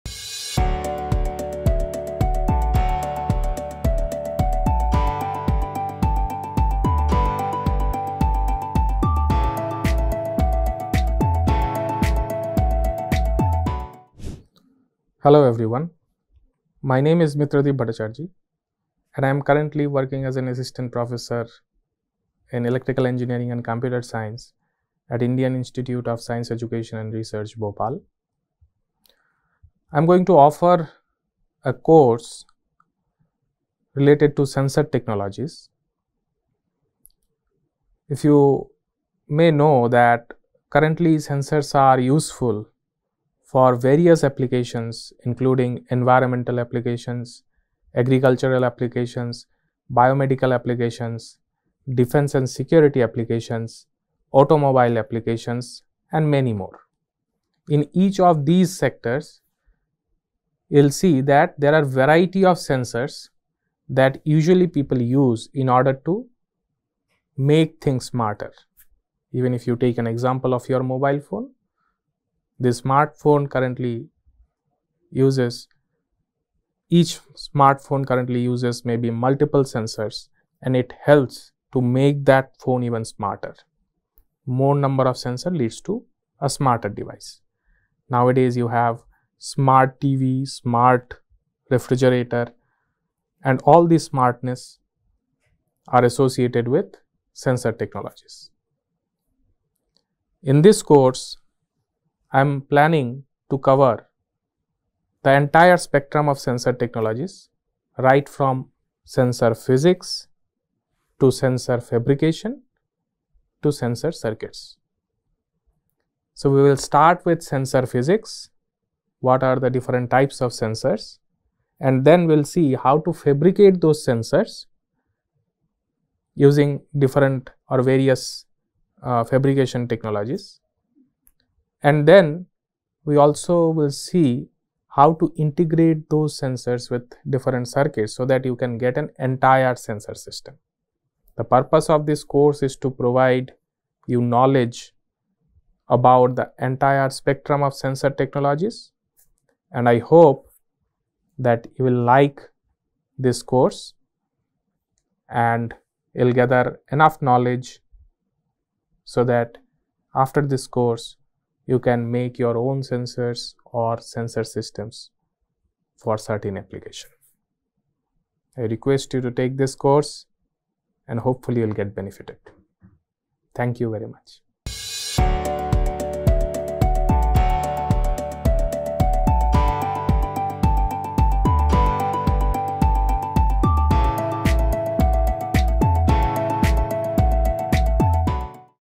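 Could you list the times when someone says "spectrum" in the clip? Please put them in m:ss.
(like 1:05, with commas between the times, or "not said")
1:45, 2:27.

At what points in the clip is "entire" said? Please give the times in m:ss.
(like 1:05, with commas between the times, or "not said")
1:45, 2:19, 2:26.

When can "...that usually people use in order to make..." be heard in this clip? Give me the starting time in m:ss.
1:03.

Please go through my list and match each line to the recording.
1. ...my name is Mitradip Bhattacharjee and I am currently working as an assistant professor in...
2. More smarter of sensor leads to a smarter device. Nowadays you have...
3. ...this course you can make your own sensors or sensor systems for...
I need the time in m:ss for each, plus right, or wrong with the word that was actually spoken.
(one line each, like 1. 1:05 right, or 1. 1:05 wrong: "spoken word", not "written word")
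1. 0:16 right
2. 1:24 wrong: "number", not "smarter"
3. 2:40 right.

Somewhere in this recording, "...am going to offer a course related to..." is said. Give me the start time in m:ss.
0:29.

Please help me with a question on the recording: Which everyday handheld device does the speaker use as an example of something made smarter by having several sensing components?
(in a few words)
Mobile phone.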